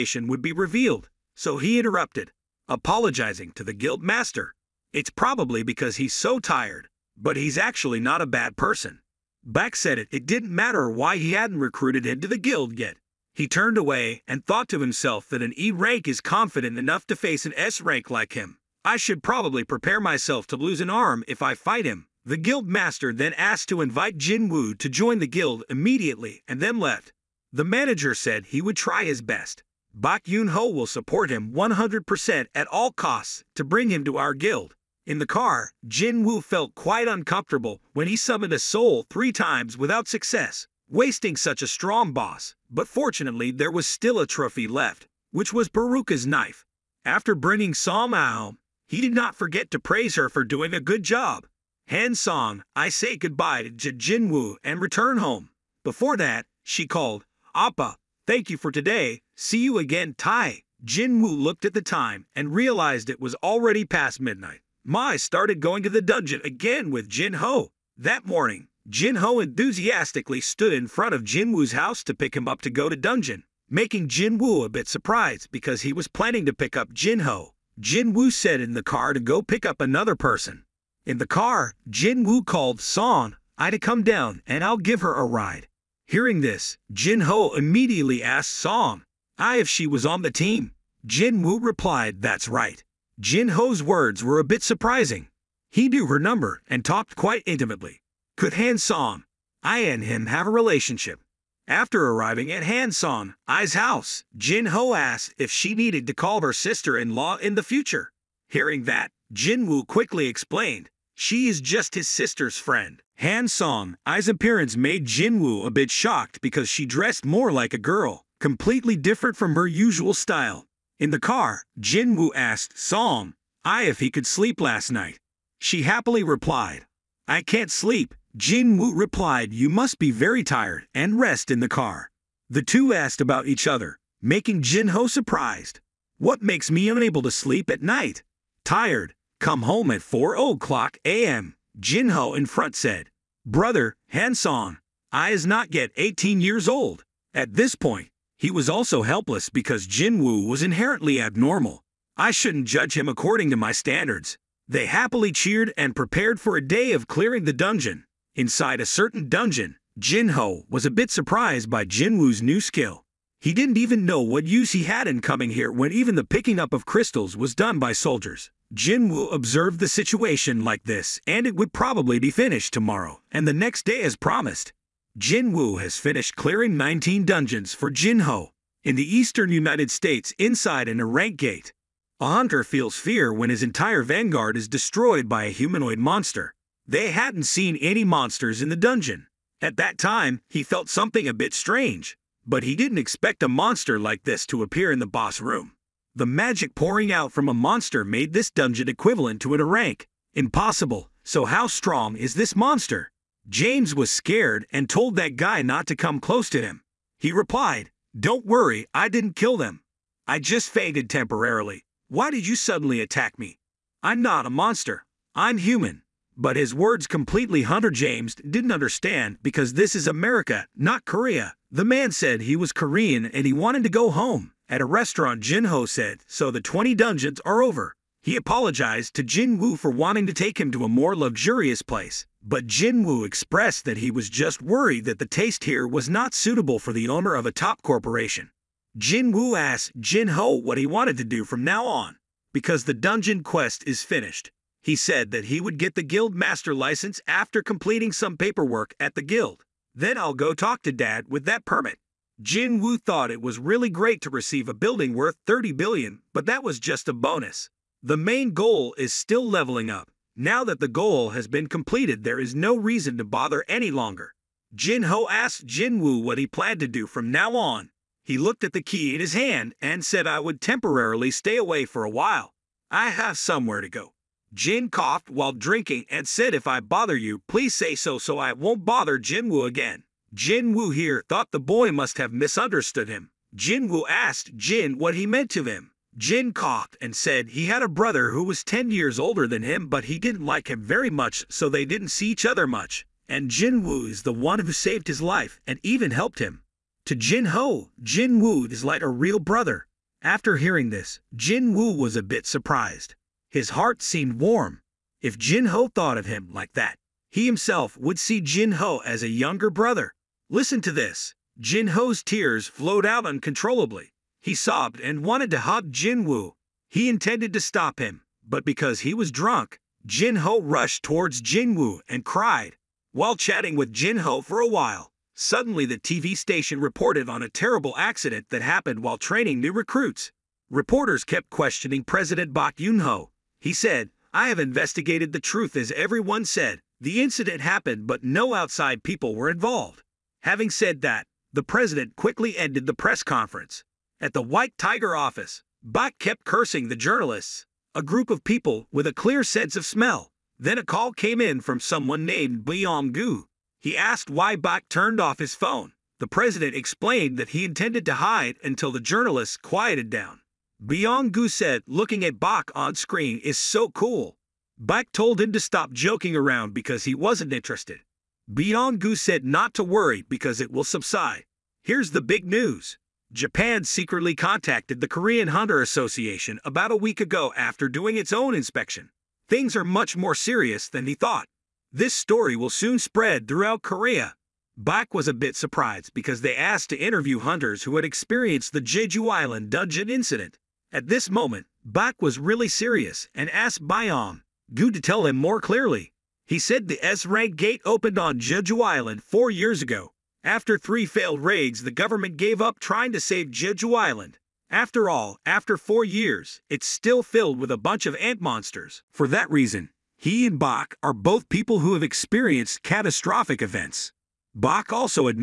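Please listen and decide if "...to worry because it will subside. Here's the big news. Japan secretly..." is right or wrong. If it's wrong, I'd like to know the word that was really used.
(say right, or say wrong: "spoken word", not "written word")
right.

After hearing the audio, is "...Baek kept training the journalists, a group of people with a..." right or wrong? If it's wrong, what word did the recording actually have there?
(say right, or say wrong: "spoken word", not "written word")
wrong: "cursing", not "training".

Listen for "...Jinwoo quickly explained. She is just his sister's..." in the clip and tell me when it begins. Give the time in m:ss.
1:49.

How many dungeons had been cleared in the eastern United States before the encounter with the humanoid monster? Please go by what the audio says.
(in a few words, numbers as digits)
19.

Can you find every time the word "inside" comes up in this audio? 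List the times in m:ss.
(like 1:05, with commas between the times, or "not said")
2:38, 3:00.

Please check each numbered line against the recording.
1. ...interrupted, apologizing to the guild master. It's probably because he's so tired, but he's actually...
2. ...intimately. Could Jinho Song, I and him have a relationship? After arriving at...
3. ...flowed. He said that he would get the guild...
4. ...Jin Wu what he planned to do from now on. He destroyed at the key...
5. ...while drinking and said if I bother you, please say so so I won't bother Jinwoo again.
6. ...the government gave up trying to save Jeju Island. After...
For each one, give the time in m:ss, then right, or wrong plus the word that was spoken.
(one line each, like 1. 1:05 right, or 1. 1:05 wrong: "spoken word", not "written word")
1. 0:01 right
2. 1:37 wrong: "Han", not "Jinho"
3. 4:04 wrong: "finished", not "flowed"
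4. 4:25 wrong: "looked", not "destroyed"
5. 4:35 right
6. 6:41 right.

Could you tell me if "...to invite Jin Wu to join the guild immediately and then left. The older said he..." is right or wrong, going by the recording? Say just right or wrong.
wrong.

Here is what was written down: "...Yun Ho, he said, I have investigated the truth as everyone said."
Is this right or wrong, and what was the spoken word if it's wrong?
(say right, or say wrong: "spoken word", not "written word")
right.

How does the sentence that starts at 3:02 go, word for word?
A hunter feels fear when his entire vanguard is destroyed by a humanoid monster.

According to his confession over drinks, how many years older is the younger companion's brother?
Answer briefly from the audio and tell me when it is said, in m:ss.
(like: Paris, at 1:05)
10, at 4:48.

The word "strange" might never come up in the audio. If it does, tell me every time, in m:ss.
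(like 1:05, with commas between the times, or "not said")
3:11.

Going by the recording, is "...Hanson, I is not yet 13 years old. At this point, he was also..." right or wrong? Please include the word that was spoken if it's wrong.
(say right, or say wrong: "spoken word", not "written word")
wrong: "18", not "13".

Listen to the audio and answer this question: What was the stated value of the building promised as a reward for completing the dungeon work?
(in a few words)
30 billion.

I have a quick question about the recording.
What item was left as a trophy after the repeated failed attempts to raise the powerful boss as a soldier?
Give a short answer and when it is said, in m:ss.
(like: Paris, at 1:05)
Baruka's knife, at 0:45.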